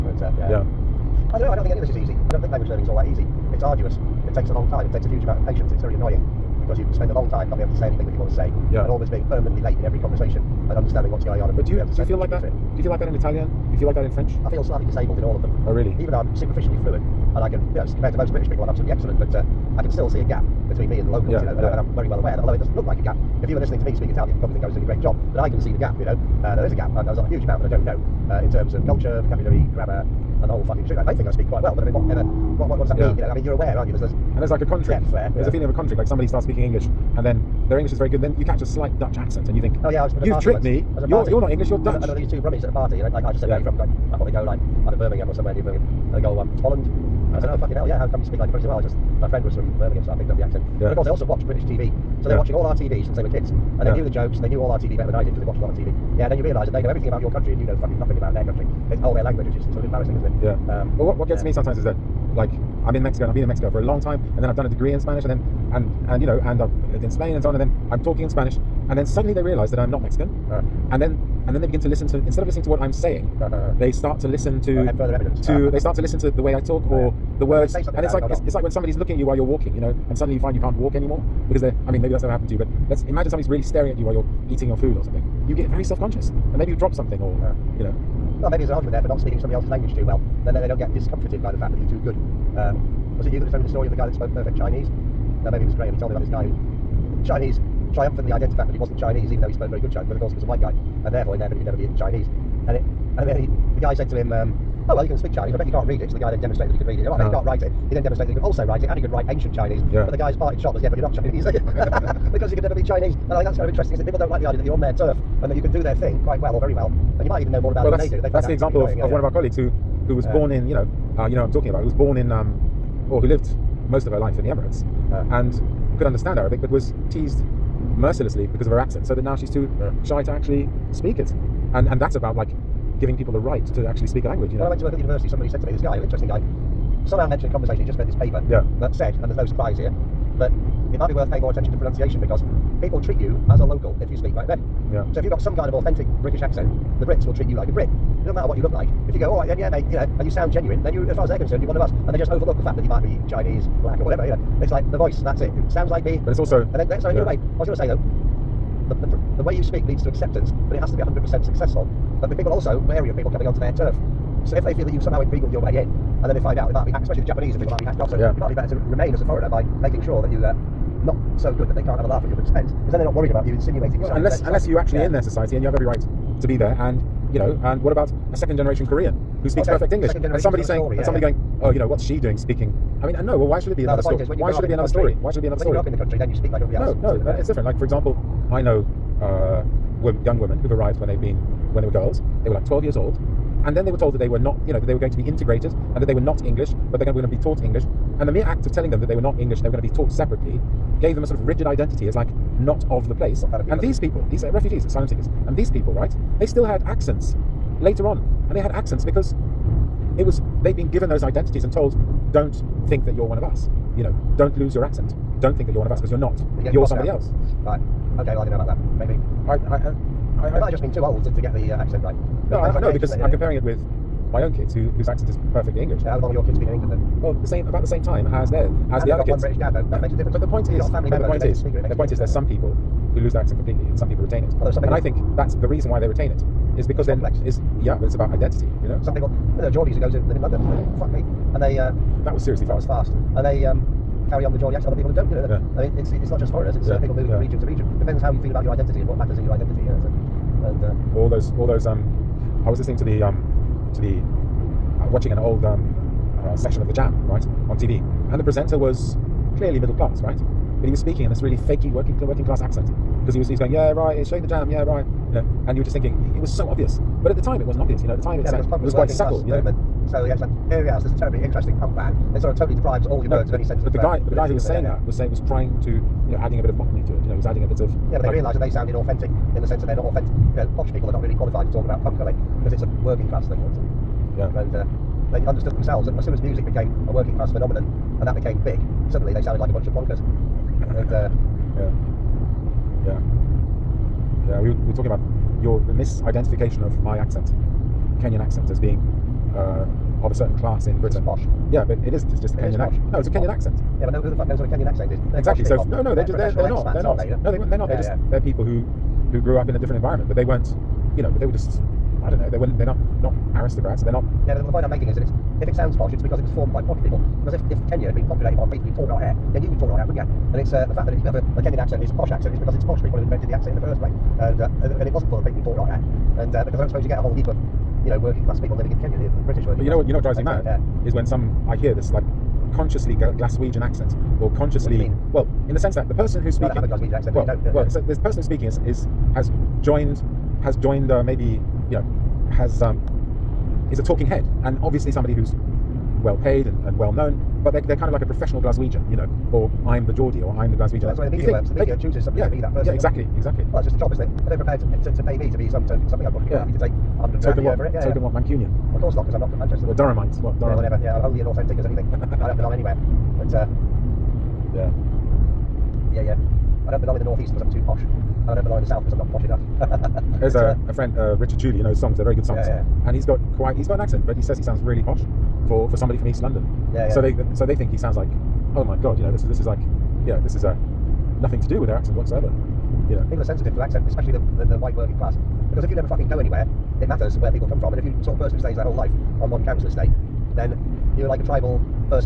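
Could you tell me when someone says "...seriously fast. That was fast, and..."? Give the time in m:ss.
4:02.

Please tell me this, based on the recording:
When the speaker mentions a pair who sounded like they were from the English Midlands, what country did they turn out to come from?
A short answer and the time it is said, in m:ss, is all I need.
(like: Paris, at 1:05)
Holland, at 0:46.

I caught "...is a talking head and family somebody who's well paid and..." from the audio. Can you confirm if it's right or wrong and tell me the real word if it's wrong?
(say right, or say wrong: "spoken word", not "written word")
wrong: "obviously", not "family".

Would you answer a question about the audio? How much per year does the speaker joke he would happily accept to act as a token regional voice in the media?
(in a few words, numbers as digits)
100 grand.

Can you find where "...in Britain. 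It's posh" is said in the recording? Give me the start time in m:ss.
5:00.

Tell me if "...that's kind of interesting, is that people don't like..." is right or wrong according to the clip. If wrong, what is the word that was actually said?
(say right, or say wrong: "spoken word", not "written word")
right.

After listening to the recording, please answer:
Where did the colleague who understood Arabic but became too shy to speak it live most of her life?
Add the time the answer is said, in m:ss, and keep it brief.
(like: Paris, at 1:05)
the Emirates, at 2:04.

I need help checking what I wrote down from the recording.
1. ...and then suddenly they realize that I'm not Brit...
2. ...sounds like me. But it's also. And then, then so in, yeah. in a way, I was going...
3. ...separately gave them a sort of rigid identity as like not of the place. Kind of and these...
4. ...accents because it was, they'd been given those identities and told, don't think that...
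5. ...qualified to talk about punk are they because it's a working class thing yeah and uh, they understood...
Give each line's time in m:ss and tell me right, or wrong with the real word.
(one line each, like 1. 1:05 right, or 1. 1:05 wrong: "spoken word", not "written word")
1. 1:08 wrong: "Mexican", not "Brit"
2. 2:35 right
3. 3:20 right
4. 3:28 right
5. 4:41 right.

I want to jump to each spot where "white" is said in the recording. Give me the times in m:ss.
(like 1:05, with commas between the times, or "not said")
1:40, 6:24.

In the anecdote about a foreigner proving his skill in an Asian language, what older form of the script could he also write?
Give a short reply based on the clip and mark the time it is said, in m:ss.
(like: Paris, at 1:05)
ancient Chinese, at 1:49.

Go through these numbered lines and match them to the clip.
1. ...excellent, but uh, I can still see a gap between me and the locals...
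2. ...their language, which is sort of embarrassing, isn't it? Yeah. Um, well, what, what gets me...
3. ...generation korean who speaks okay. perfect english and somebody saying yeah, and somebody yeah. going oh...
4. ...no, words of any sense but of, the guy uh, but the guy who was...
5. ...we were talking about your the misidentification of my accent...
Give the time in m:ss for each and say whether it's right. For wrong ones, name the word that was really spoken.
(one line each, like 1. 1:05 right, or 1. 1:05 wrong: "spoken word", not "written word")
1. 0:18 right
2. 0:59 right
3. 2:58 right
4. 4:33 right
5. 4:54 right.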